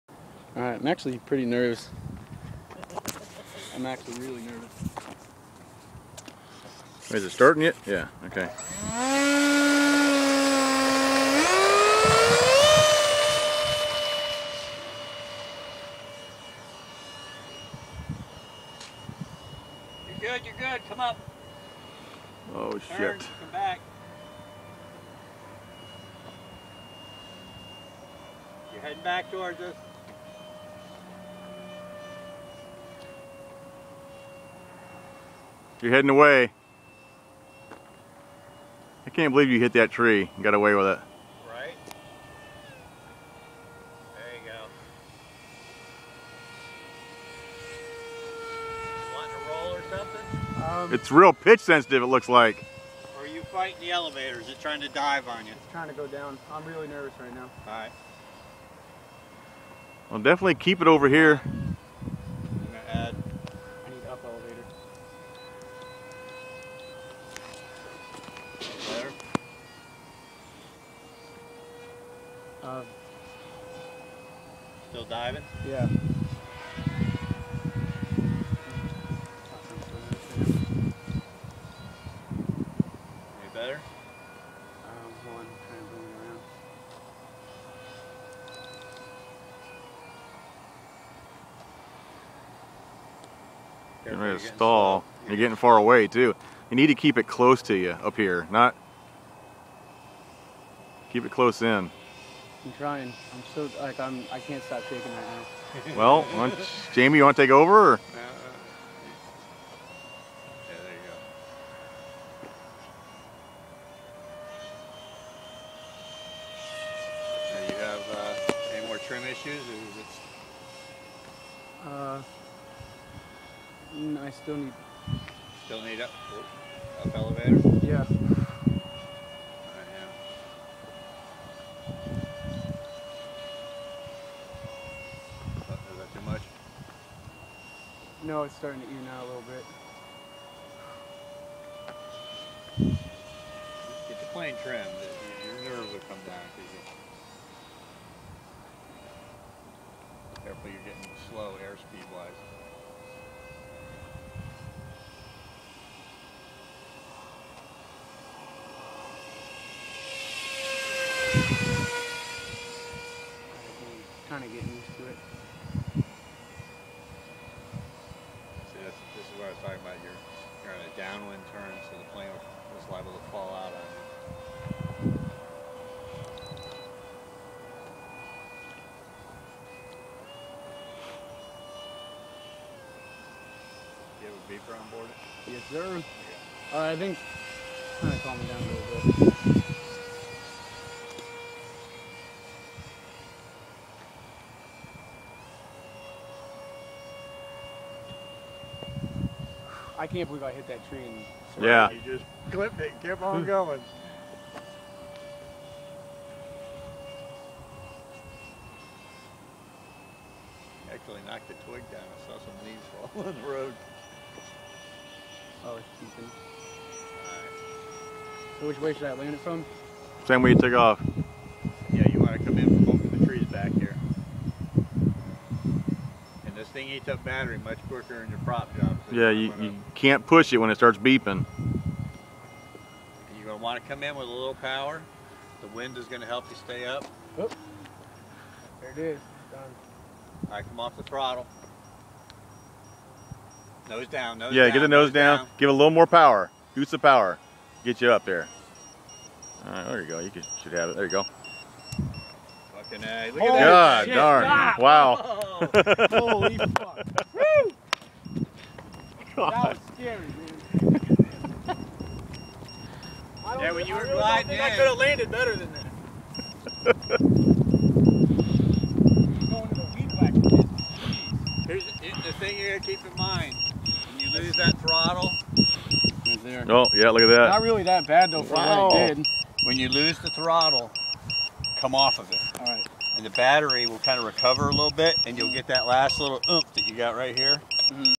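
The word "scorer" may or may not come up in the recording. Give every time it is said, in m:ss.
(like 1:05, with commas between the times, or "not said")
not said.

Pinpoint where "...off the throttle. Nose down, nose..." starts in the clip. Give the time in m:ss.
4:00.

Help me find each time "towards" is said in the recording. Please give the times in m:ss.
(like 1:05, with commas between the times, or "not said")
0:29.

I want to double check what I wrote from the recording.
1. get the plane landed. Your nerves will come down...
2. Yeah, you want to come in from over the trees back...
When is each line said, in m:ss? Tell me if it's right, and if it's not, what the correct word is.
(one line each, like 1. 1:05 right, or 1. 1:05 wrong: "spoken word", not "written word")
1. 2:24 wrong: "trimmed", not "landed"
2. 3:41 right.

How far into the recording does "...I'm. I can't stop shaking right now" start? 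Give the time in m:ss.
1:43.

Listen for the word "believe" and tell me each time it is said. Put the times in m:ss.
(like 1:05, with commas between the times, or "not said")
0:39, 3:20.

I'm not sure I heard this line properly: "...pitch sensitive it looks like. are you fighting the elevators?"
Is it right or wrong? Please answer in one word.
right.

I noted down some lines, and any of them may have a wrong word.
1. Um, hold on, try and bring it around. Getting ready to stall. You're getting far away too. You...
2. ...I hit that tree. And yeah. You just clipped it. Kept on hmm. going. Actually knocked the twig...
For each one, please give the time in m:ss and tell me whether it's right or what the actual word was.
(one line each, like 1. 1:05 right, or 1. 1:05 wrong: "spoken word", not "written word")
1. 1:24 right
2. 3:20 right.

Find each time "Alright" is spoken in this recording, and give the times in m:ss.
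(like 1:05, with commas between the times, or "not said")
0:00, 0:57.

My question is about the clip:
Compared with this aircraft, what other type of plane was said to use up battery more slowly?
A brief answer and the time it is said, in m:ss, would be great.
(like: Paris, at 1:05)
prop job, at 3:48.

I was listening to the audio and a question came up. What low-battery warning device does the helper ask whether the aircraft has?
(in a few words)
beeper.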